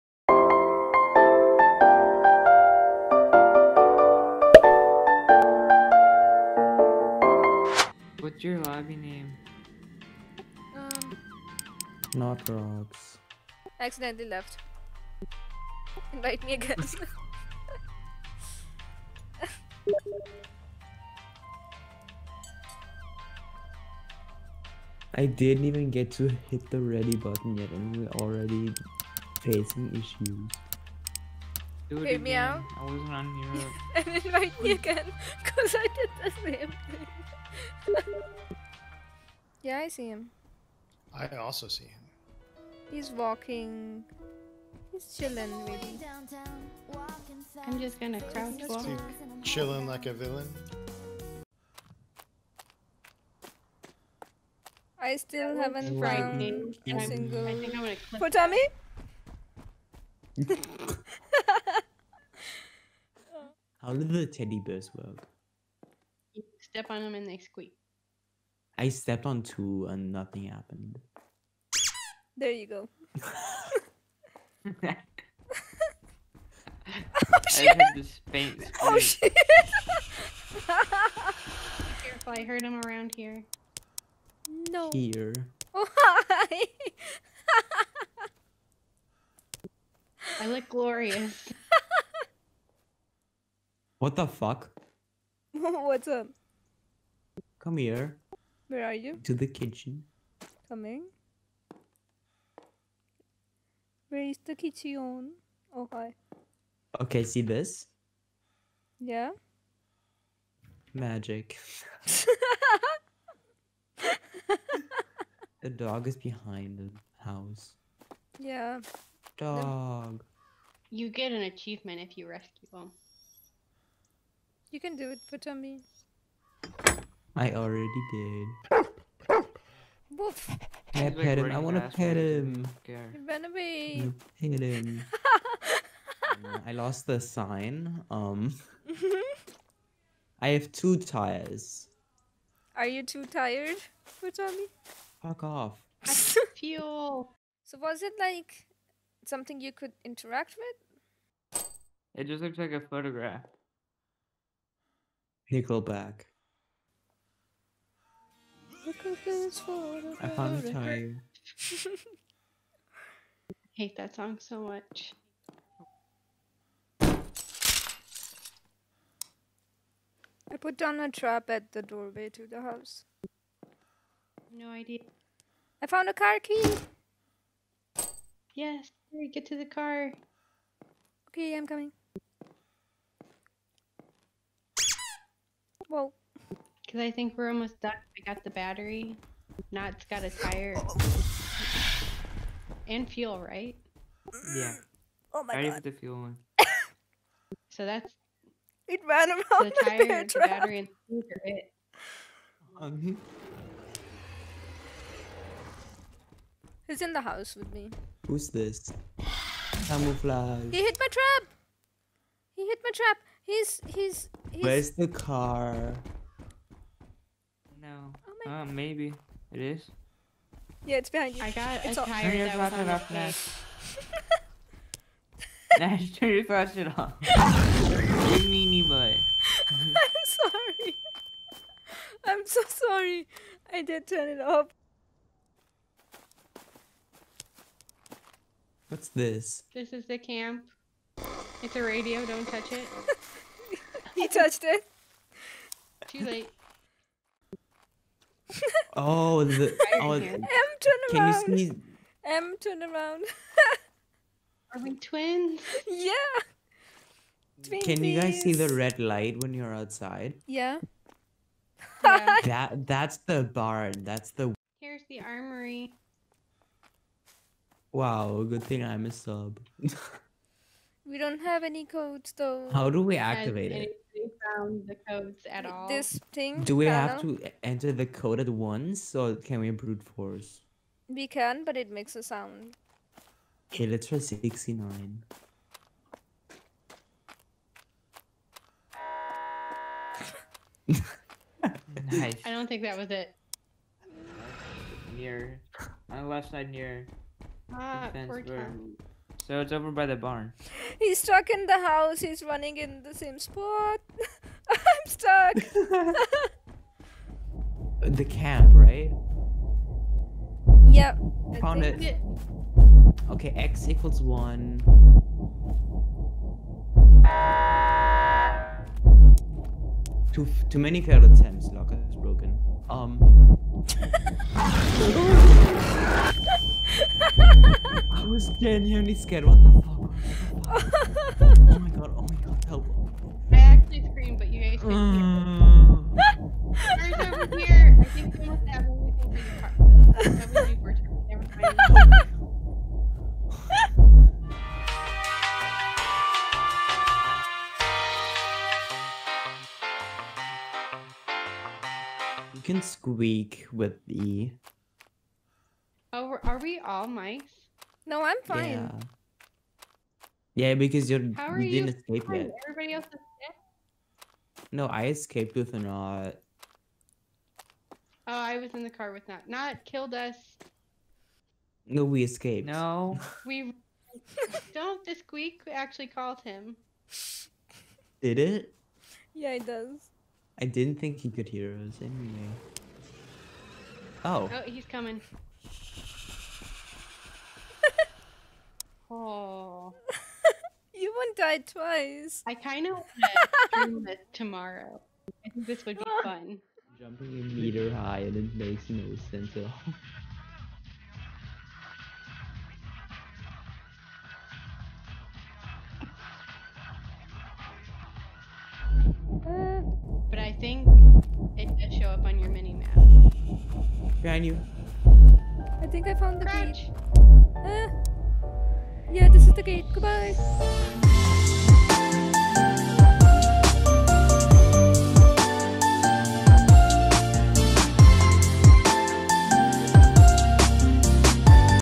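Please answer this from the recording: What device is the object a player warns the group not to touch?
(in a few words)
A radio.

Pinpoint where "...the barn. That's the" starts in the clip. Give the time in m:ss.
4:23.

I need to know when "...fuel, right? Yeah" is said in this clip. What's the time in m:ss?
3:13.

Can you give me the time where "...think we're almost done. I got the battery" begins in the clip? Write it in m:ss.
3:07.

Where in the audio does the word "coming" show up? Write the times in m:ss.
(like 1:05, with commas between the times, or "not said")
1:40, 3:01, 6:24.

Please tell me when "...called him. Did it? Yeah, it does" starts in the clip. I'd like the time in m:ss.
6:16.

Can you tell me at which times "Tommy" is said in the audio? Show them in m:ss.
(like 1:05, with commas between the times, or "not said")
2:05, 2:24.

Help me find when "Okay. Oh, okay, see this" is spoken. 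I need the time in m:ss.
1:45.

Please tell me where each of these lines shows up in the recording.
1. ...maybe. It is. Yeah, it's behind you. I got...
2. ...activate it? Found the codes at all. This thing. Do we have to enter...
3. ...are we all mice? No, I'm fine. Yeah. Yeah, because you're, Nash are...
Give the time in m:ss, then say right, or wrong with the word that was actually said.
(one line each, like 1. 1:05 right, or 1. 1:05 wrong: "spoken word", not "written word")
1. 3:38 right
2. 4:33 right
3. 5:56 wrong: "How", not "Nash".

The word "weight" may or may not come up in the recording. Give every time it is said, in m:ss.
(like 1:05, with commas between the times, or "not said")
not said.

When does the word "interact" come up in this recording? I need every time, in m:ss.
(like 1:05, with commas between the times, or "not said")
2:30.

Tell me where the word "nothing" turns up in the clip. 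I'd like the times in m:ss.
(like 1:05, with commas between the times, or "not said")
1:10.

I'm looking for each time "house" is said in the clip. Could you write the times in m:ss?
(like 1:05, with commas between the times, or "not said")
1:57, 2:52, 3:27, 5:01.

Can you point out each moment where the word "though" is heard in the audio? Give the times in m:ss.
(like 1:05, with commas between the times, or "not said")
4:32.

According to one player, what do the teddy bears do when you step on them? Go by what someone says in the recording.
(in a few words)
They squeak.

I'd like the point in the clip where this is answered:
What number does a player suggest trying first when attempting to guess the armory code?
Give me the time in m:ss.
4:44.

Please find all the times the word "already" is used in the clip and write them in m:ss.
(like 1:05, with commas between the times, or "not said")
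0:28, 2:07.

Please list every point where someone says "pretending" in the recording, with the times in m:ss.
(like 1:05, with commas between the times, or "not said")
not said.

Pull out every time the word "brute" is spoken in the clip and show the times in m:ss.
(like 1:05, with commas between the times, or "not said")
4:39.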